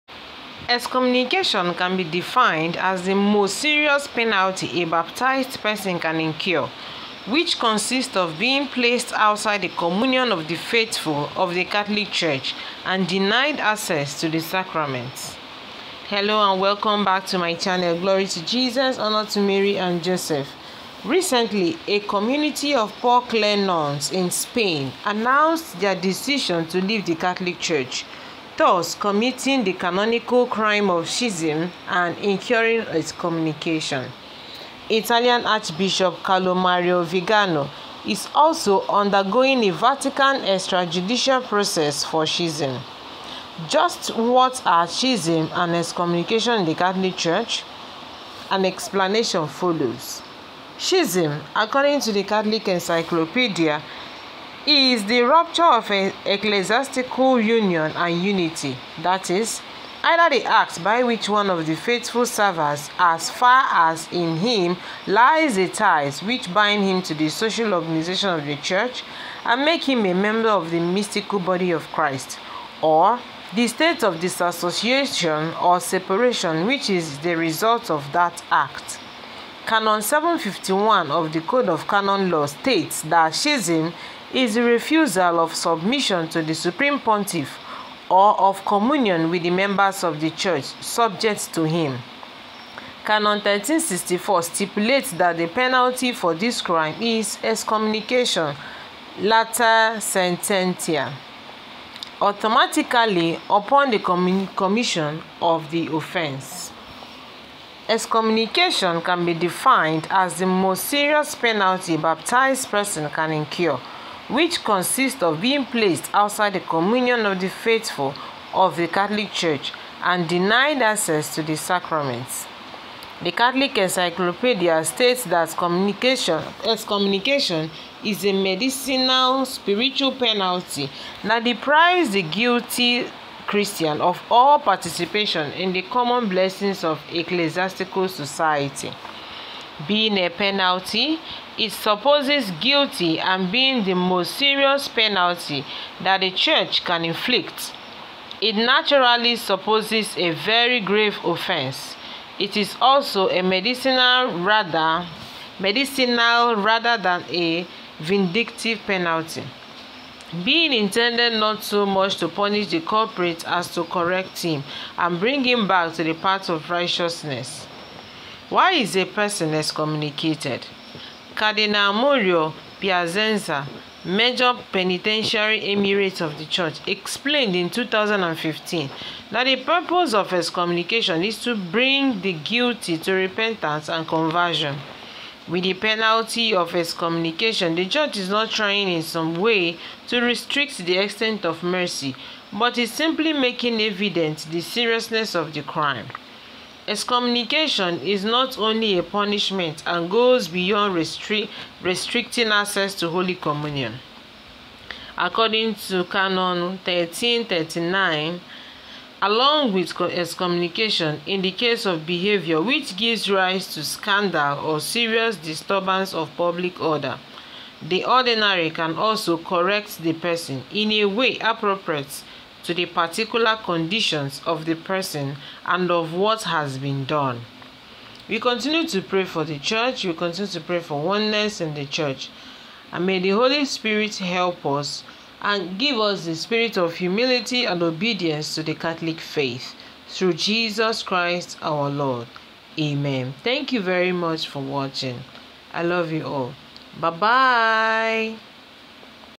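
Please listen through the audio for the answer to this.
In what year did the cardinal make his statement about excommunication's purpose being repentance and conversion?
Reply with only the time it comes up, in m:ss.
2:57.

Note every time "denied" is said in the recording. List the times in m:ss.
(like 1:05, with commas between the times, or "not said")
0:13, 2:00.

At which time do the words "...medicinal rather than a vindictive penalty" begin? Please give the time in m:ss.
2:35.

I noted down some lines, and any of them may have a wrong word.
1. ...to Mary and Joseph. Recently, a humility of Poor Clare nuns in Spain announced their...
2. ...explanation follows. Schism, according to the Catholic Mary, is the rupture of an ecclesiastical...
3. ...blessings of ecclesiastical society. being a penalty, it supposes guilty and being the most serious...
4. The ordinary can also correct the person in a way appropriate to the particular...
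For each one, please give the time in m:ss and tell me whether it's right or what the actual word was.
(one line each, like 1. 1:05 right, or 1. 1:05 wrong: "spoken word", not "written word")
1. 0:19 wrong: "community", not "humility"
2. 0:48 wrong: "Encyclopedia", not "Mary"
3. 2:16 right
4. 3:37 right.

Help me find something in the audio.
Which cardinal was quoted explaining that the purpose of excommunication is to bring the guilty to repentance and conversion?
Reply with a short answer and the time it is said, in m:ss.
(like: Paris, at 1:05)
Mauro Piacenza, at 2:51.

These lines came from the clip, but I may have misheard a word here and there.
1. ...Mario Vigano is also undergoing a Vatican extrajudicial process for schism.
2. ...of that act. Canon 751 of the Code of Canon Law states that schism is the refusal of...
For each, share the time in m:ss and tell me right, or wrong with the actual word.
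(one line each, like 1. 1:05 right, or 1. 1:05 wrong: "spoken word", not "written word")
1. 0:36 right
2. 1:17 right.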